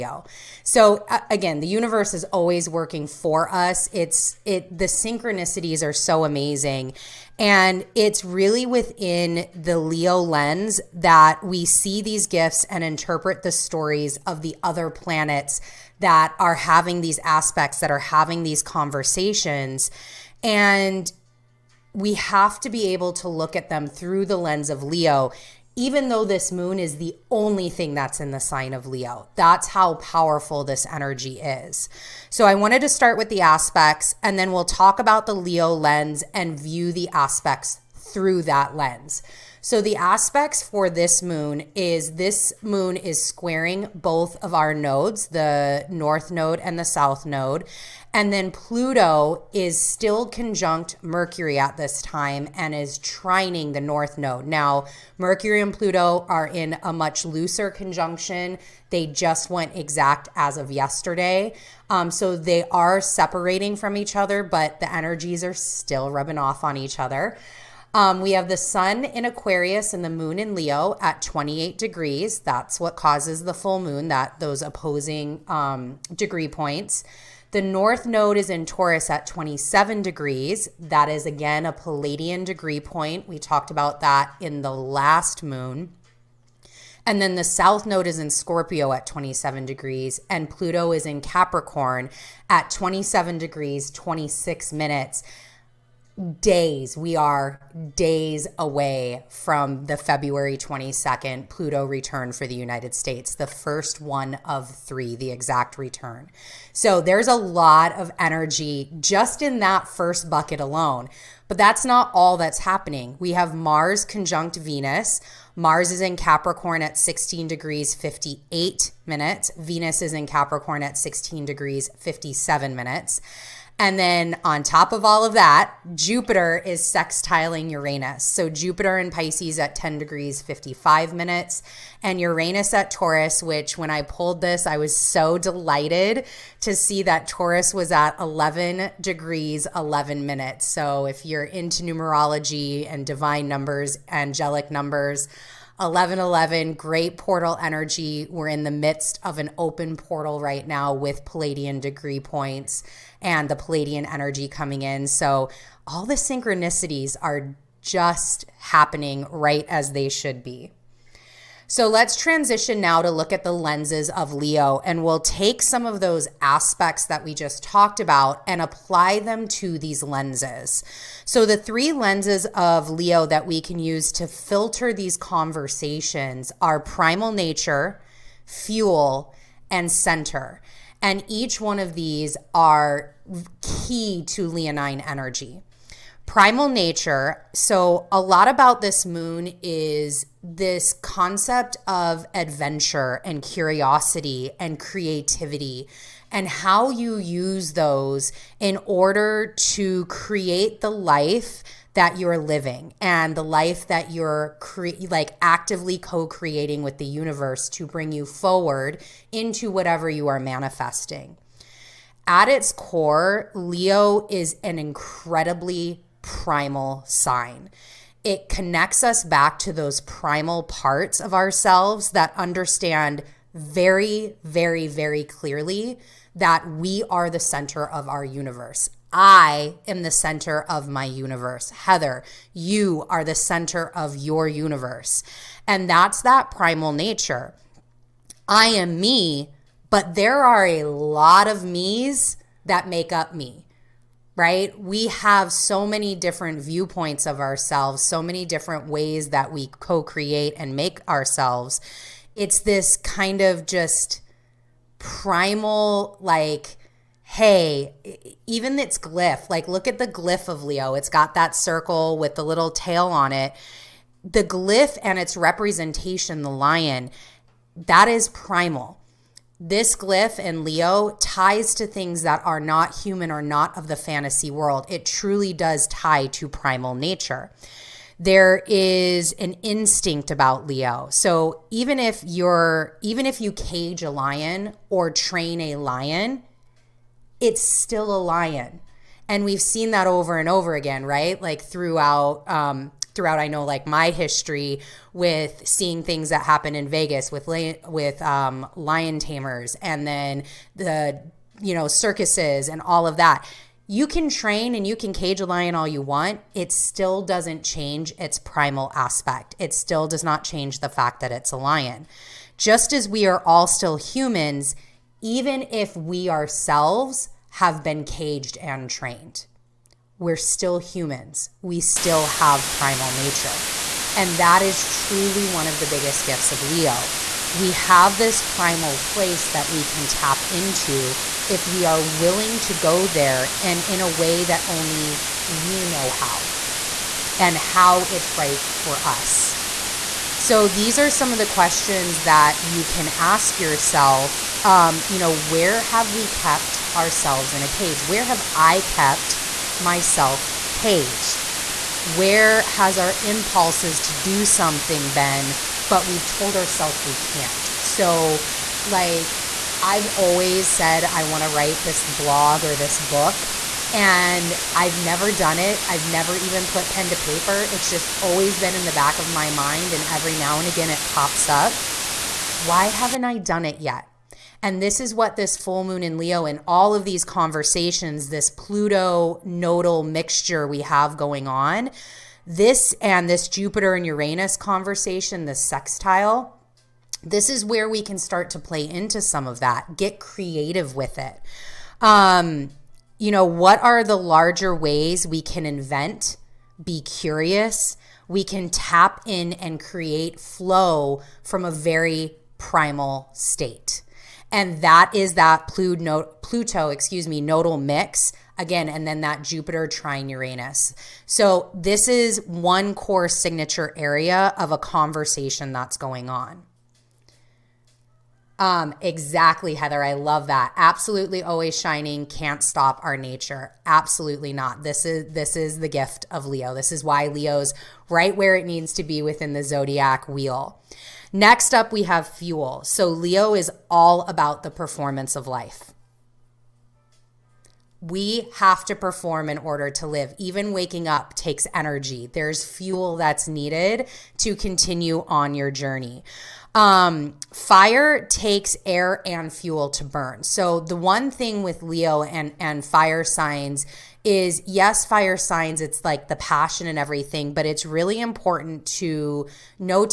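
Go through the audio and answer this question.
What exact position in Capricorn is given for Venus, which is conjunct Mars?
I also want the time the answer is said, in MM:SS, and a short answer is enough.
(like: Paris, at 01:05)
16 degrees 57 minutes, at 02:00.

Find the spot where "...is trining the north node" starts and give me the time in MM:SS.
00:52.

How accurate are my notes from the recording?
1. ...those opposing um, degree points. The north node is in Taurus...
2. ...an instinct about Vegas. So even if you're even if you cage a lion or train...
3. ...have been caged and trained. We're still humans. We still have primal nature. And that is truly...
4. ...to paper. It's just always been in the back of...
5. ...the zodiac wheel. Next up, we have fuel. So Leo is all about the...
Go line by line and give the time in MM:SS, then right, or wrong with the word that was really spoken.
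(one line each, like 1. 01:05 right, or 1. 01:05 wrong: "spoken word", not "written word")
1. 01:14 right
2. 04:39 wrong: "Leo", not "Vegas"
3. 05:17 right
4. 06:07 right
5. 07:09 right.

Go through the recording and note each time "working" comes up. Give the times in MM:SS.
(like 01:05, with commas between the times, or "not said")
00:02.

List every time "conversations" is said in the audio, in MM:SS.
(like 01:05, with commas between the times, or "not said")
00:18, 02:55, 06:17, 06:24, 06:54.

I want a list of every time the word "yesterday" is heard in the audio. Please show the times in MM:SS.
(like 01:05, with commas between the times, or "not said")
01:00.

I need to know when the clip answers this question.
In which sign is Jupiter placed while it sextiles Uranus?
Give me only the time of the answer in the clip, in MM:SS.
02:09.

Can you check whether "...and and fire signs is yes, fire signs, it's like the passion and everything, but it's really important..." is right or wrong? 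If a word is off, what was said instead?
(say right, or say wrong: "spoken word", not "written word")
right.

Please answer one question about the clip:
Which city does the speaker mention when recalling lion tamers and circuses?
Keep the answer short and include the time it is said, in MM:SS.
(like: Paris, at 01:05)
Vegas, at 04:56.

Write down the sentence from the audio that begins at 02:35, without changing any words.
So all the synchronicities are just happening right as they should be.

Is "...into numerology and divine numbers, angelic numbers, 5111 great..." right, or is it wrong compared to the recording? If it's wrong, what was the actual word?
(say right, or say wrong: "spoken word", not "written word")
wrong: "1111", not "5111".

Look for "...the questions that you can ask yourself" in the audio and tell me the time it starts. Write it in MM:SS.
05:41.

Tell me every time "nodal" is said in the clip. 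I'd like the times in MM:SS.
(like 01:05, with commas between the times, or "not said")
06:19, 06:47.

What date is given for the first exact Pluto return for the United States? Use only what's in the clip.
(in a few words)
February 22nd.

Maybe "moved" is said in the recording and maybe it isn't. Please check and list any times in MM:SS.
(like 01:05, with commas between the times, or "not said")
not said.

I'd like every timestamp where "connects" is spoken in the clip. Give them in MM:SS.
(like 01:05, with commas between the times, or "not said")
03:38.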